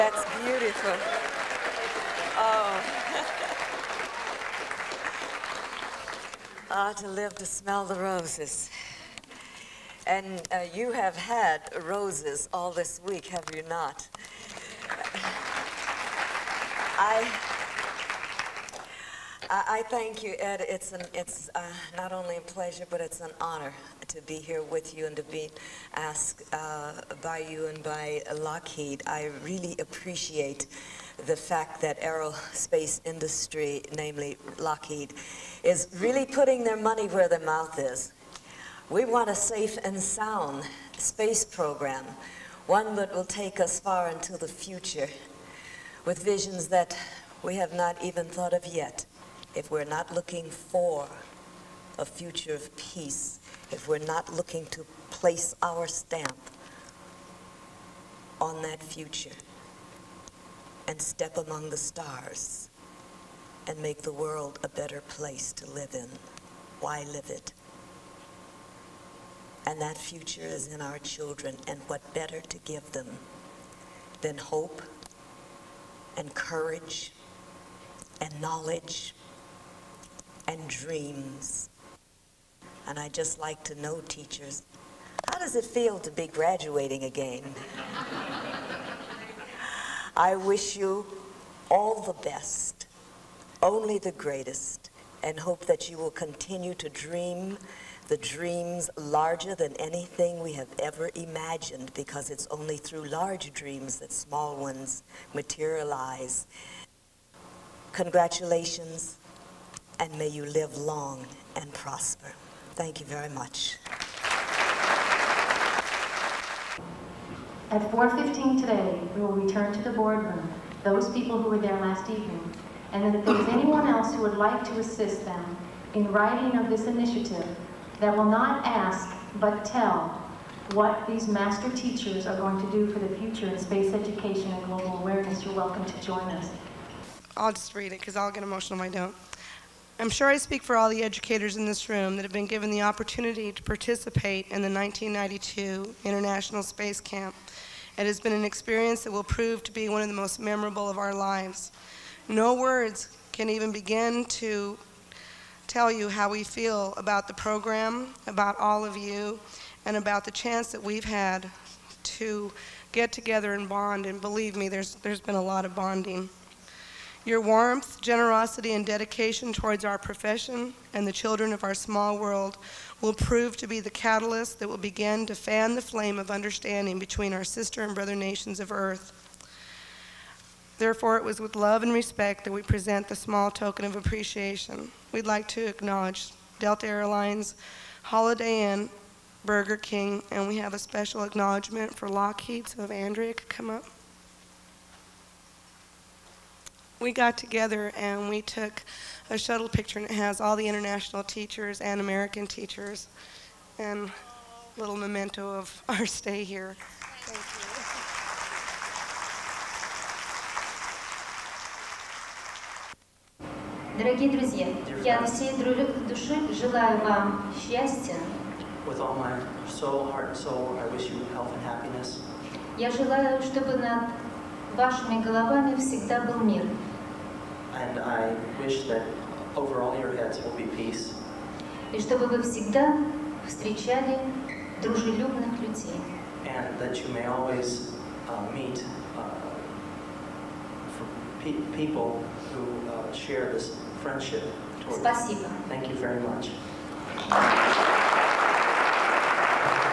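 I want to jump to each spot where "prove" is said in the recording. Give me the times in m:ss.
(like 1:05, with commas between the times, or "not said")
2:29, 2:53.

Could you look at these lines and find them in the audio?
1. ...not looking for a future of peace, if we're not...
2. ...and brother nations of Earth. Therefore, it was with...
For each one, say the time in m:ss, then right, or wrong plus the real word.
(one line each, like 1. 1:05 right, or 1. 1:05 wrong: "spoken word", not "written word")
1. 0:49 right
2. 2:57 right.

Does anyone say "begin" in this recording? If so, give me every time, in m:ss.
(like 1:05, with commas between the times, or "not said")
2:33, 2:54.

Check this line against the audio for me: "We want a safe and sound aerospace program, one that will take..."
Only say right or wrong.
wrong.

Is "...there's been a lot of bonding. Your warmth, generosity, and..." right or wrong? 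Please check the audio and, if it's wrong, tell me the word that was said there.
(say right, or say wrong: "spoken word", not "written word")
right.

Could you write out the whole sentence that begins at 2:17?
I'll just read it because I'll get emotional if I don't.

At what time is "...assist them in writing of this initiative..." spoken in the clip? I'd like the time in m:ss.
2:04.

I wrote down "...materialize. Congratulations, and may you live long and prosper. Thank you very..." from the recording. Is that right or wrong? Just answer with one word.
right.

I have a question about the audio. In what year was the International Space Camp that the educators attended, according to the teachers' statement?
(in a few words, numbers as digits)
1992.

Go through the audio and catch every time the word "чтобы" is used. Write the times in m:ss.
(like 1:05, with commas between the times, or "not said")
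3:43, 3:52.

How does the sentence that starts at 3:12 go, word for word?
So if Andrea could come up.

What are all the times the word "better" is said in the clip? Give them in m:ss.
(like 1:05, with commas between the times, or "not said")
1:04, 1:12.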